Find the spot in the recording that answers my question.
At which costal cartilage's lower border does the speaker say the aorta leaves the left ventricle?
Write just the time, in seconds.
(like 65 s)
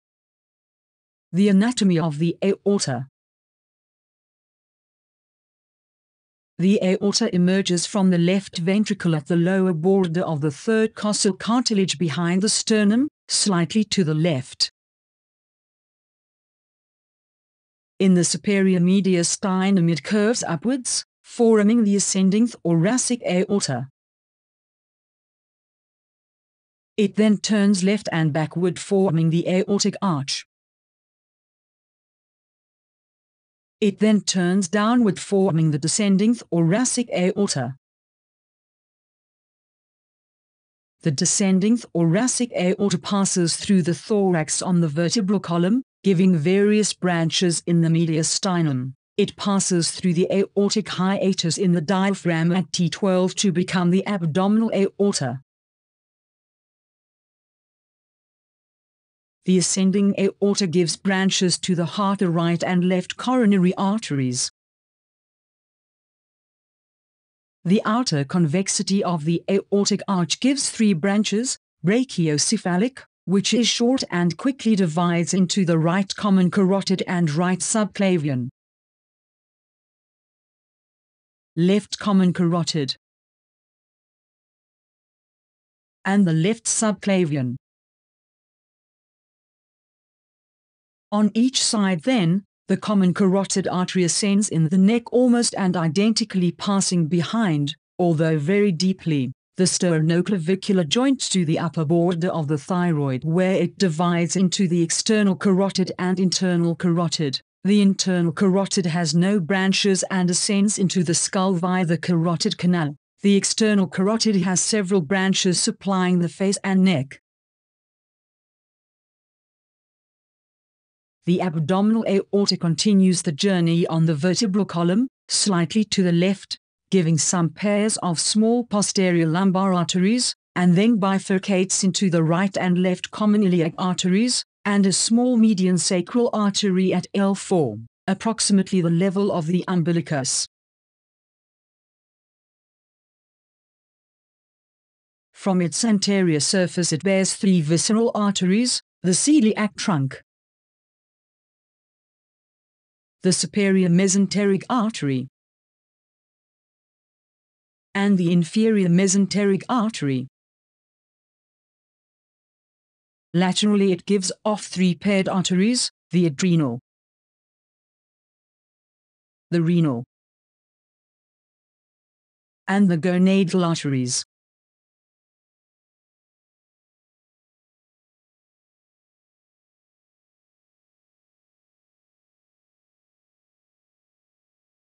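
10 s.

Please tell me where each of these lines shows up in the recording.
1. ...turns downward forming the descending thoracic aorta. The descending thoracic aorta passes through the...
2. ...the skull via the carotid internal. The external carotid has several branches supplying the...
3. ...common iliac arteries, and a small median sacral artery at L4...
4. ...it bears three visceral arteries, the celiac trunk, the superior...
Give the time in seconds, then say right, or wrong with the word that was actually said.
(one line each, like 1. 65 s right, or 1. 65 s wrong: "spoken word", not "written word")
1. 34 s right
2. 111 s wrong: "canal", not "internal"
3. 133 s right
4. 146 s right.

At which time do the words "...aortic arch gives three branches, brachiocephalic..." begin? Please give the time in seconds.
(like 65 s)
69 s.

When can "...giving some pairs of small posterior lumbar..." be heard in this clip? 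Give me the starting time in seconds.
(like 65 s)
126 s.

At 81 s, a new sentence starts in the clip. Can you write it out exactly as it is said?
Left common carotid and the left subclavian.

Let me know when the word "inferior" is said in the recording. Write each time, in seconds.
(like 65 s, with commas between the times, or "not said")
158 s.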